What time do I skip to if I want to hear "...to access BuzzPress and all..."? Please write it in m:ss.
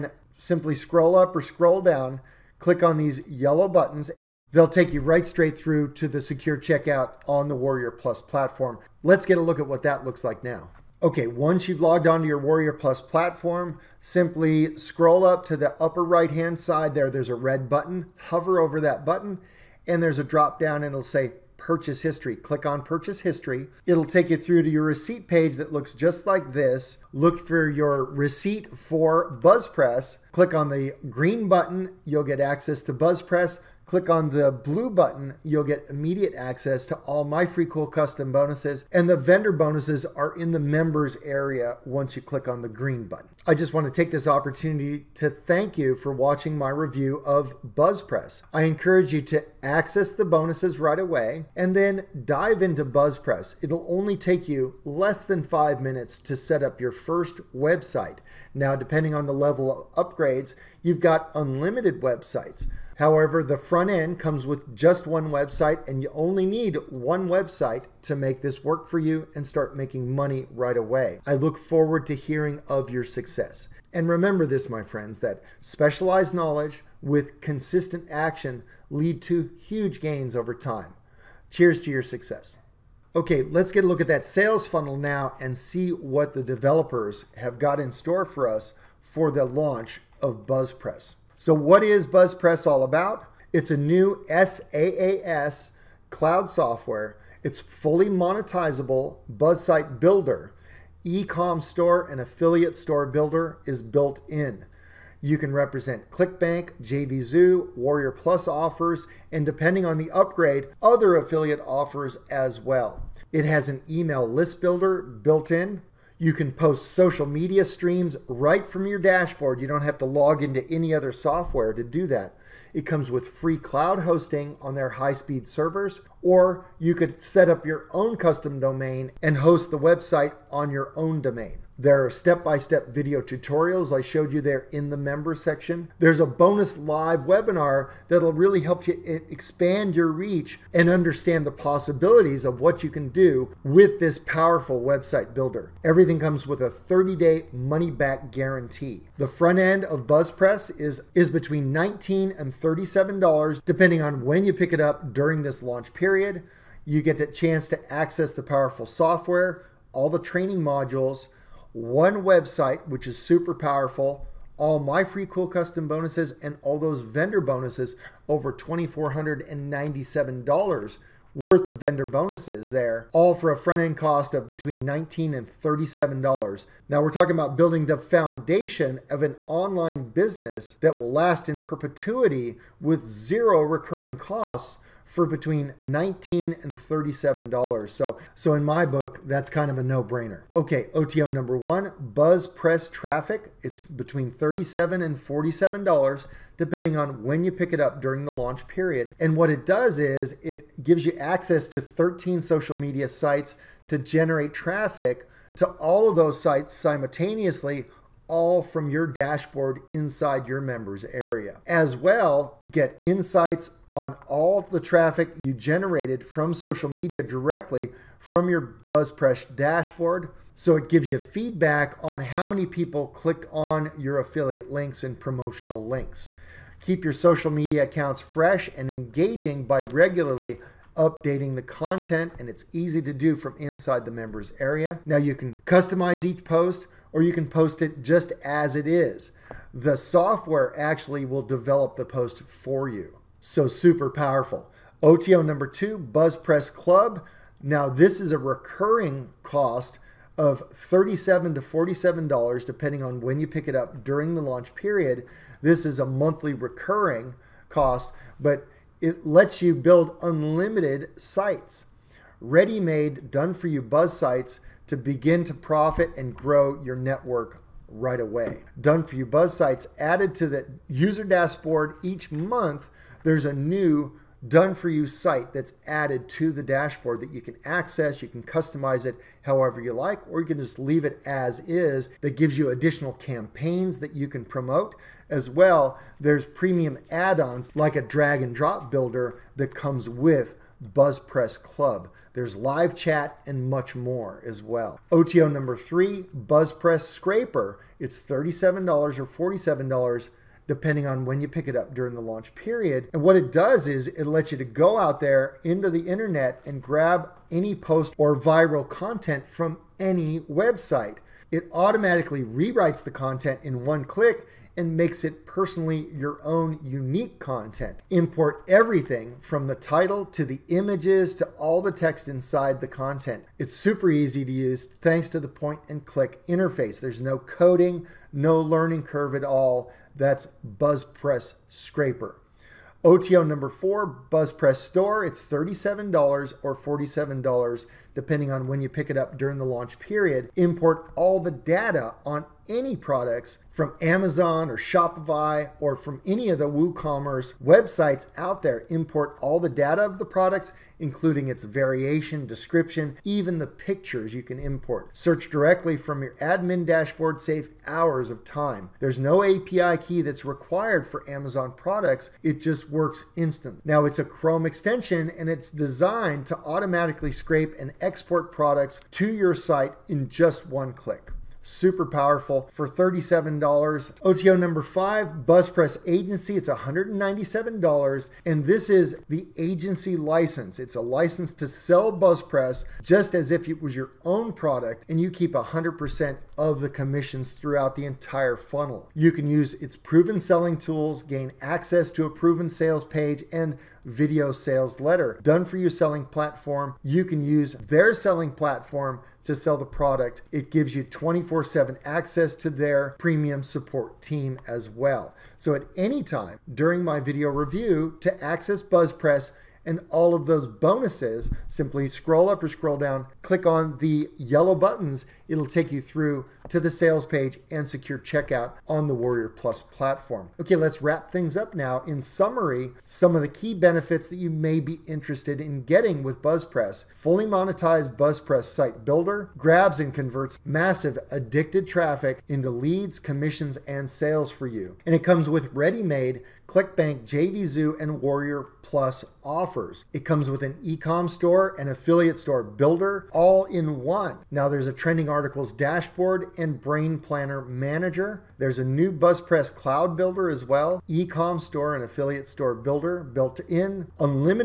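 6:48.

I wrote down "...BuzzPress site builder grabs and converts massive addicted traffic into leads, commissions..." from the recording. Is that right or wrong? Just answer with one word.
right.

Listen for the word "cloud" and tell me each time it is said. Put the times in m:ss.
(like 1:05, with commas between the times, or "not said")
1:36, 2:03, 7:29.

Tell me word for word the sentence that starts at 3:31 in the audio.
As well, get insights on all the traffic you generated from social media directly from your BuzzPress dashboard.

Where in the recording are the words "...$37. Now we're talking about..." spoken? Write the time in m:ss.
2:55.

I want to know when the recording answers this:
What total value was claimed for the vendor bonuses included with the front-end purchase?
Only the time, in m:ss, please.
2:48.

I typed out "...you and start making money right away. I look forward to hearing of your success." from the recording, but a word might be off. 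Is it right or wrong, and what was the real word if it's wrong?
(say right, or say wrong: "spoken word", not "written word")
right.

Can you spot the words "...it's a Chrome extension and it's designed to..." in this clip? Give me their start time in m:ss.
6:04.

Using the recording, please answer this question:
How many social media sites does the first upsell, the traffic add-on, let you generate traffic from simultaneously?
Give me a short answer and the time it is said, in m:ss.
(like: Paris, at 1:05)
13, at 3:21.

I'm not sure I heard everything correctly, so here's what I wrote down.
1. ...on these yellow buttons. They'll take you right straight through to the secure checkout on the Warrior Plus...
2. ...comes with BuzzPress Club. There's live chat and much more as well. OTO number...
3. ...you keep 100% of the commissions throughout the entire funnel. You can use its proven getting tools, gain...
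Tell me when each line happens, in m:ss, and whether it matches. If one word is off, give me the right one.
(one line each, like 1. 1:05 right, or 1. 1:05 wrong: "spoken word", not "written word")
1. 0:02 right
2. 4:49 right
3. 6:25 wrong: "selling", not "getting".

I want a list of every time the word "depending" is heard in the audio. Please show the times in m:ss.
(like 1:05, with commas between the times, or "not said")
0:58, 1:49, 2:33, 3:16, 4:12, 5:00, 5:38.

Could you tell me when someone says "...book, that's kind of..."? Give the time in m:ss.
3:08.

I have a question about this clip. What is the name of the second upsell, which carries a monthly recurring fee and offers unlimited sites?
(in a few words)
BuzzPress Club.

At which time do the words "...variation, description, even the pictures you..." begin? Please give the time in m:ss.
5:51.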